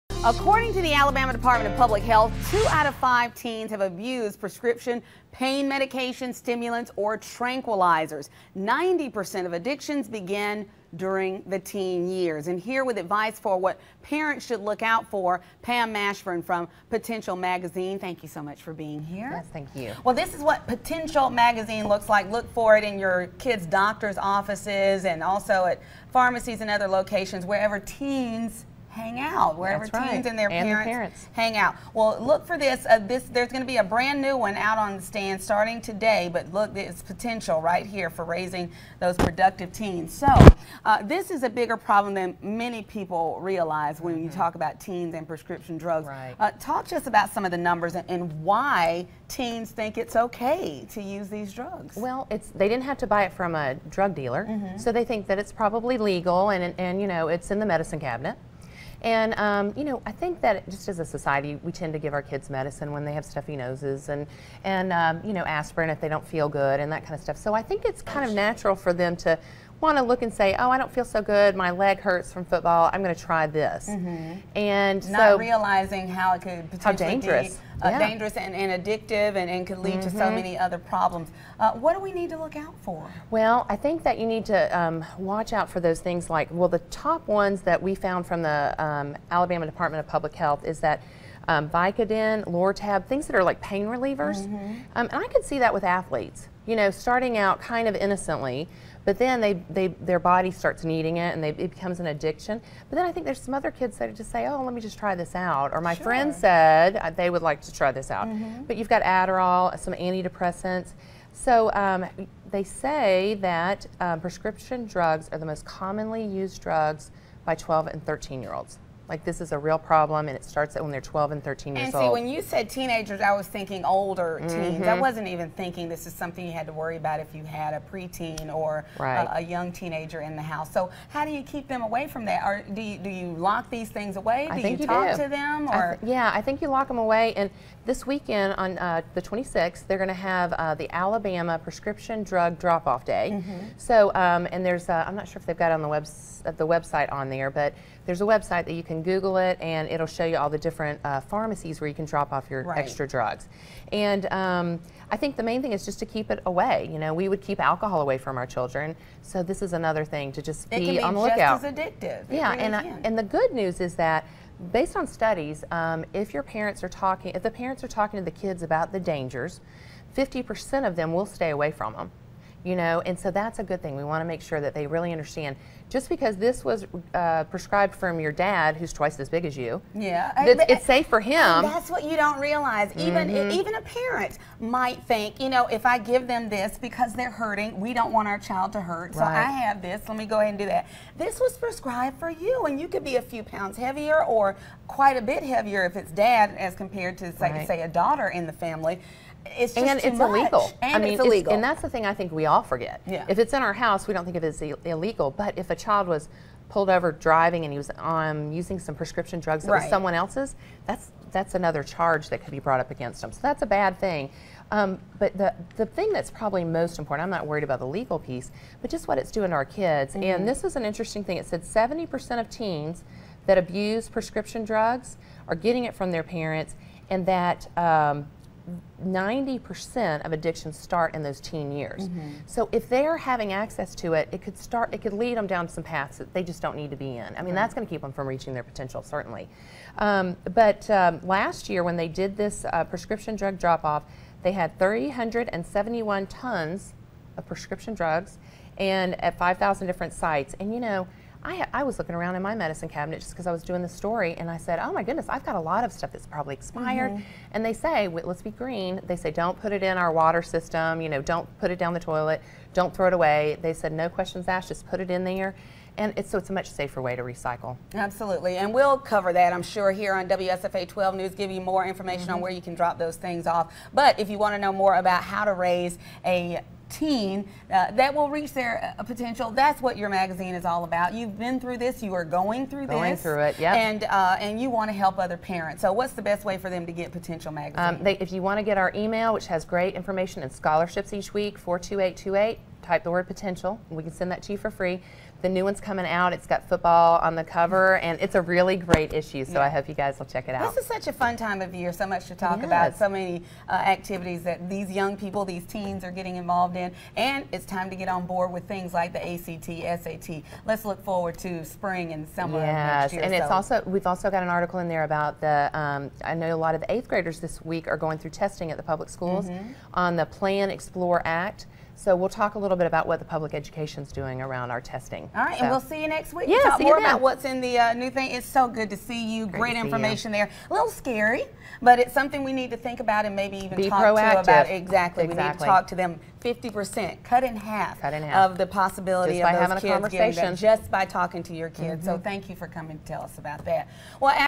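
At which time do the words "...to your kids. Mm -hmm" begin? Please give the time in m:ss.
5:41.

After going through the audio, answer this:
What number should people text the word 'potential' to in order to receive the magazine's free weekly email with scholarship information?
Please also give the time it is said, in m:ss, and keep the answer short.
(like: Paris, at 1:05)
42828, at 4:51.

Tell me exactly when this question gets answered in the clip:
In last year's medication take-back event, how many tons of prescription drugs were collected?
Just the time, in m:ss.
4:04.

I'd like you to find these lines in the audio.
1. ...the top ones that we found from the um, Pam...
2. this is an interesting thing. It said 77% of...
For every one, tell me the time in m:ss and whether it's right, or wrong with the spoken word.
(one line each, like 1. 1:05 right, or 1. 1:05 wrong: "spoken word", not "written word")
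1. 1:26 wrong: "Alabama", not "Pam"
2. 3:40 wrong: "70", not "77".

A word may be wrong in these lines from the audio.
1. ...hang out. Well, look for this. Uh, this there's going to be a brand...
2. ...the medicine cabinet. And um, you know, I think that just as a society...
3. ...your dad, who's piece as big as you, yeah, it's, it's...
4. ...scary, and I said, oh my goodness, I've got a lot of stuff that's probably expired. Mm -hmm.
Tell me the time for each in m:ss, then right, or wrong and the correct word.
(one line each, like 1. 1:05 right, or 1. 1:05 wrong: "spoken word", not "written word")
1. 0:31 right
2. 0:57 right
3. 2:58 wrong: "twice", not "piece"
4. 4:13 wrong: "story", not "scary".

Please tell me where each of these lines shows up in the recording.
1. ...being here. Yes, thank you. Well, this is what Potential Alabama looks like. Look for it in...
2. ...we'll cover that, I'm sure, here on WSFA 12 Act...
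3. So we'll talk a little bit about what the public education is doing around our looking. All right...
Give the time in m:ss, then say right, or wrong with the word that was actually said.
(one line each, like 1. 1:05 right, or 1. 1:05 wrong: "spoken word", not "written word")
1. 0:18 wrong: "Magazine", not "Alabama"
2. 4:28 wrong: "News", not "Act"
3. 5:22 wrong: "testing", not "looking".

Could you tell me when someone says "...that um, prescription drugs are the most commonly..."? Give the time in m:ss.
1:53.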